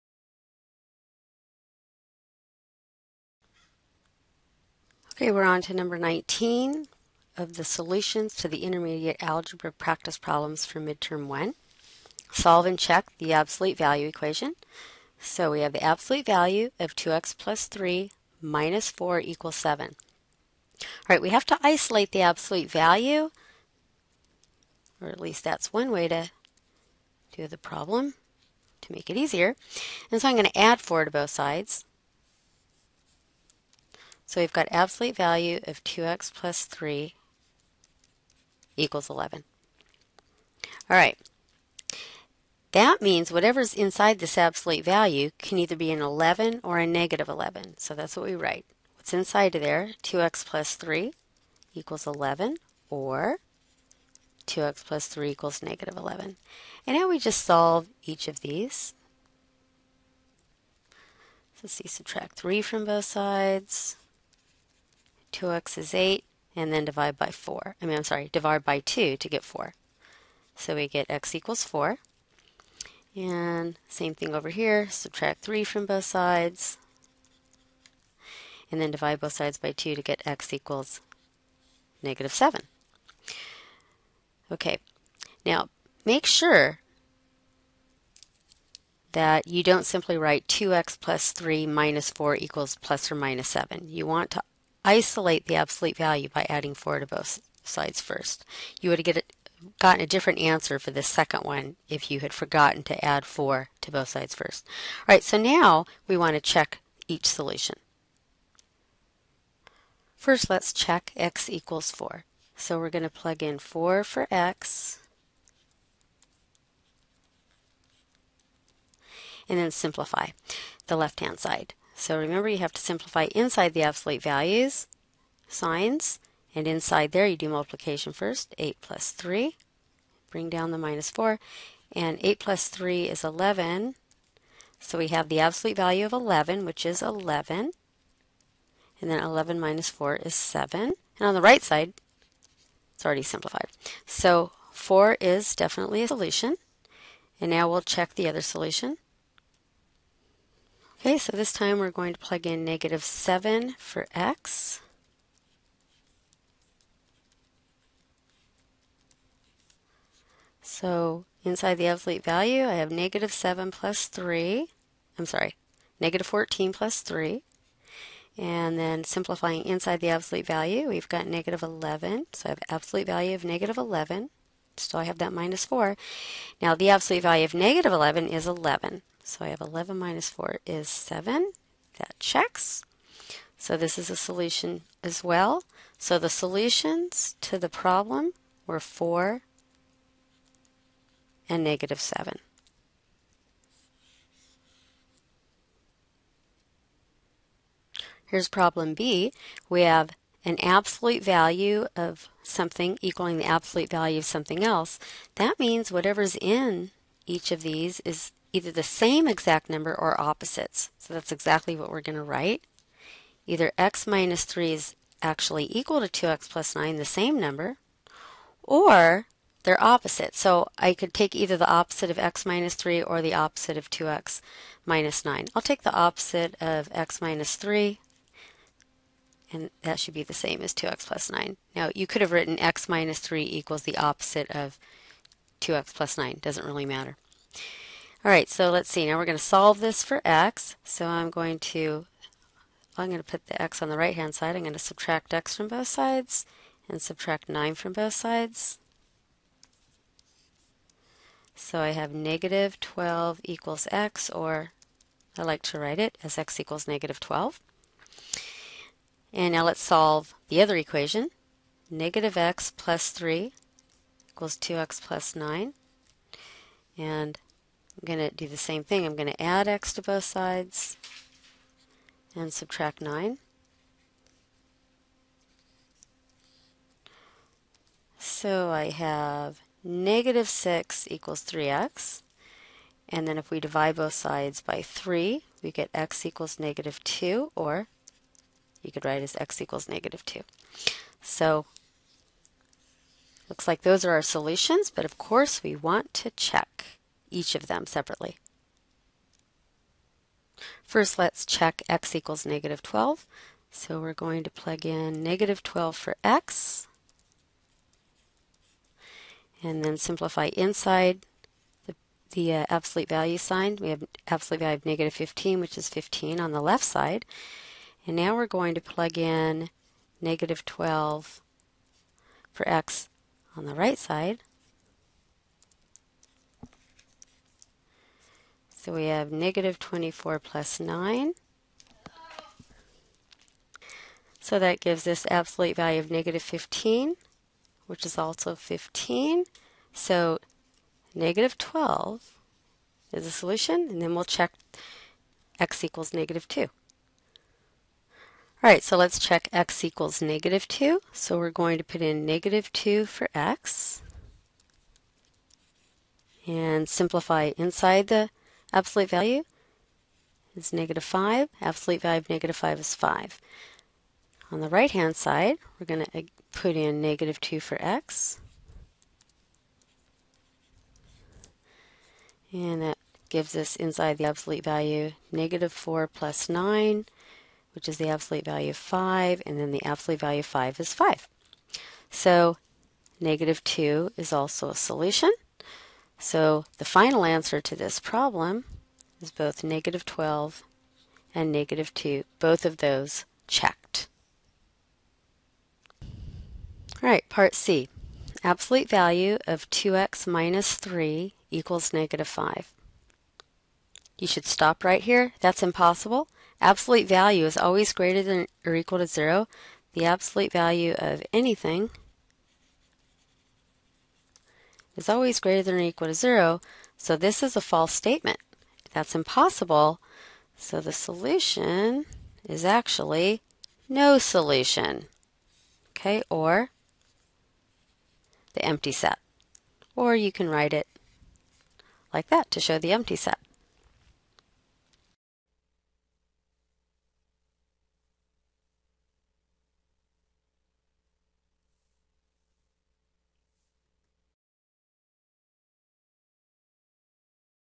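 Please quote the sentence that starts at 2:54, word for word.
Still I have that minus 4.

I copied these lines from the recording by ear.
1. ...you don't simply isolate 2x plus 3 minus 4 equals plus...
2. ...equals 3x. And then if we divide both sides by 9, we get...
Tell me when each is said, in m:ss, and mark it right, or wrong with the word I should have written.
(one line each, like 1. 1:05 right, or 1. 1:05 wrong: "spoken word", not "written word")
1. 1:29 wrong: "write", not "isolate"
2. 4:41 wrong: "3", not "9".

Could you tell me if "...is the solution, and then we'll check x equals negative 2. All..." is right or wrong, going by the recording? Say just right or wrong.
right.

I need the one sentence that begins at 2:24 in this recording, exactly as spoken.
So 4 is definitely a solution, and now we'll check the other solution.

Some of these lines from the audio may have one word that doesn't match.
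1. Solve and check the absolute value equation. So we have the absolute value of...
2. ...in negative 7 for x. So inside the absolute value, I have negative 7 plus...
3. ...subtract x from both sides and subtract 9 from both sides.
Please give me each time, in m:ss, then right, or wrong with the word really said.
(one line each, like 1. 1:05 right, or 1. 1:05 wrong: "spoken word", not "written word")
1. 0:12 right
2. 2:32 right
3. 4:04 right.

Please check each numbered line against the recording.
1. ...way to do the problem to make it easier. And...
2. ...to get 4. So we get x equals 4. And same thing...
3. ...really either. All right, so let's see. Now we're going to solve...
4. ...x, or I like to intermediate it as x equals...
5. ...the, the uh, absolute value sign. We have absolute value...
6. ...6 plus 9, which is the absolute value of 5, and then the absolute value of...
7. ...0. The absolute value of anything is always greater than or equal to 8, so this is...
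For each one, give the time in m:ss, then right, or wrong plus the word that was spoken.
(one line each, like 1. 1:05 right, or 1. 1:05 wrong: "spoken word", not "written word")
1. 0:25 right
2. 1:09 right
3. 3:56 wrong: "matter", not "either"
4. 4:13 wrong: "write", not "intermediate"
5. 5:11 right
6. 6:15 wrong: "4", not "6"
7. 6:49 wrong: "0", not "8".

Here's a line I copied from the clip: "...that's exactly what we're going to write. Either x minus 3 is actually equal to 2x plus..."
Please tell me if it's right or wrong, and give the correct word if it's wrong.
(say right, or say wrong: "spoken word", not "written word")
right.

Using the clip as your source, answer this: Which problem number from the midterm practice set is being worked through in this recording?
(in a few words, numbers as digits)
19.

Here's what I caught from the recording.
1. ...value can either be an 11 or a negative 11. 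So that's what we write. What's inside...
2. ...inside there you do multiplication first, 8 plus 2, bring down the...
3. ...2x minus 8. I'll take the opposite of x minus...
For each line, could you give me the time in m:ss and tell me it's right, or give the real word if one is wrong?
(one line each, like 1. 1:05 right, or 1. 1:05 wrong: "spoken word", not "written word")
1. 0:44 right
2. 2:06 wrong: "3", not "2"
3. 3:43 wrong: "9", not "8".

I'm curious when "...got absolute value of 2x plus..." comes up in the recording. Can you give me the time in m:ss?
0:34.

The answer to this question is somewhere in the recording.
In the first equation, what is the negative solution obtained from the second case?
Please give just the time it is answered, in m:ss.
1:20.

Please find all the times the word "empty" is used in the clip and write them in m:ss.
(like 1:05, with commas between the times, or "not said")
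7:08, 7:12.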